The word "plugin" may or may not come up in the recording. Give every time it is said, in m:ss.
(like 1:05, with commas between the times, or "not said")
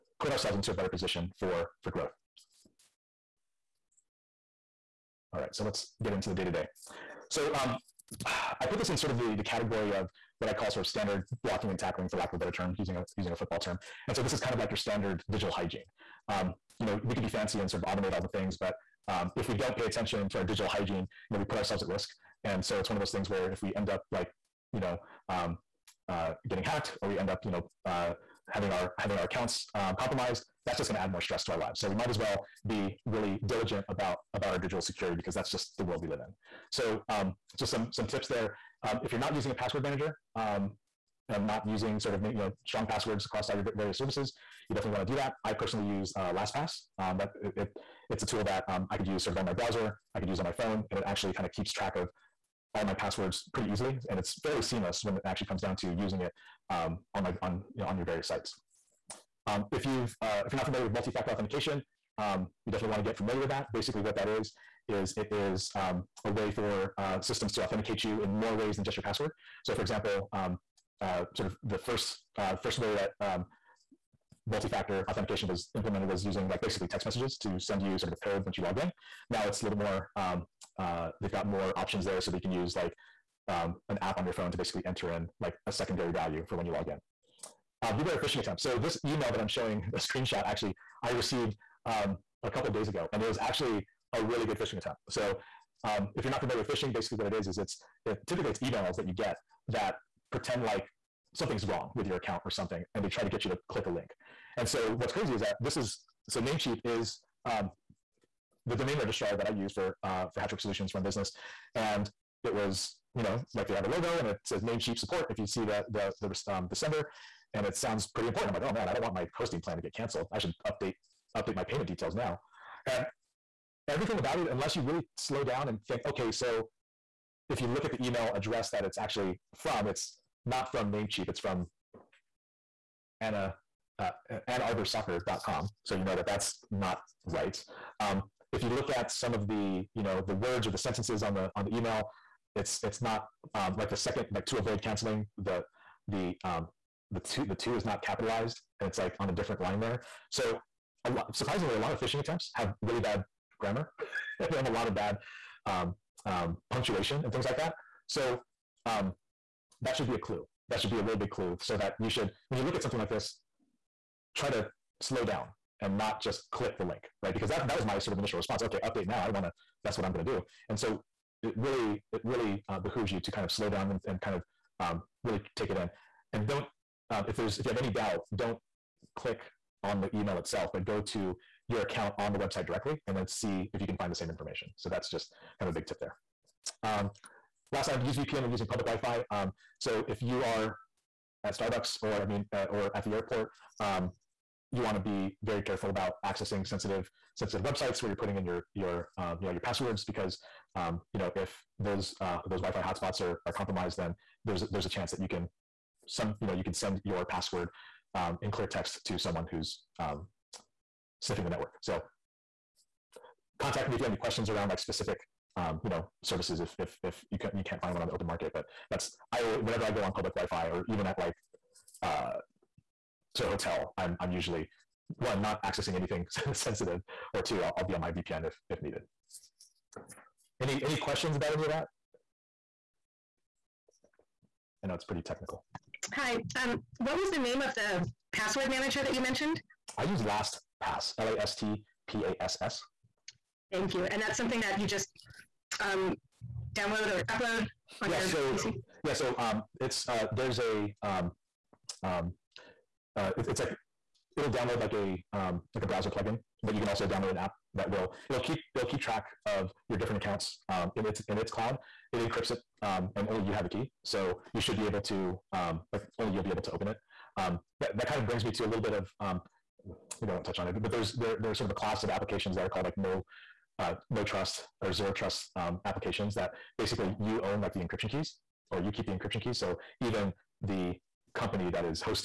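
4:16.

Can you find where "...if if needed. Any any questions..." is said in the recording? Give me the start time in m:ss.
3:48.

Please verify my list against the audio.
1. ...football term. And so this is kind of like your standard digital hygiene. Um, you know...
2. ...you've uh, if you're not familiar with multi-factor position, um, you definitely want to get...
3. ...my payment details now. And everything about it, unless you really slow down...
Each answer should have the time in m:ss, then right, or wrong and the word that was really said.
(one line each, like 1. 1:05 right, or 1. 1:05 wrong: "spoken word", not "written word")
1. 0:13 right
2. 0:59 wrong: "authentication", not "position"
3. 2:01 right.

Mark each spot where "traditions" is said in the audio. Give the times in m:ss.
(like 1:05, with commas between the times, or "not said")
not said.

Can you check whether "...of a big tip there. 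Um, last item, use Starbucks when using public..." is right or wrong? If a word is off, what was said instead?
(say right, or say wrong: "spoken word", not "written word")
wrong: "VPN", not "Starbucks".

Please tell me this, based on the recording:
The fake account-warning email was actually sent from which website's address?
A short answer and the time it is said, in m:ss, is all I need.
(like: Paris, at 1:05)
AnnArborSoccer.com, at 2:14.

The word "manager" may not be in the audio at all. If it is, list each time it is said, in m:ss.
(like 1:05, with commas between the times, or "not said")
0:39, 3:58.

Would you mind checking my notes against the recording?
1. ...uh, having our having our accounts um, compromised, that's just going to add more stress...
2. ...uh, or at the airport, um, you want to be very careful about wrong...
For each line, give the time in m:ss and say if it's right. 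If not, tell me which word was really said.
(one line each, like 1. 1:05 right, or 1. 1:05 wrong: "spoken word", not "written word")
1. 0:27 right
2. 3:12 wrong: "accessing", not "wrong".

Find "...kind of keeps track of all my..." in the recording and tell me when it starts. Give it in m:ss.
0:51.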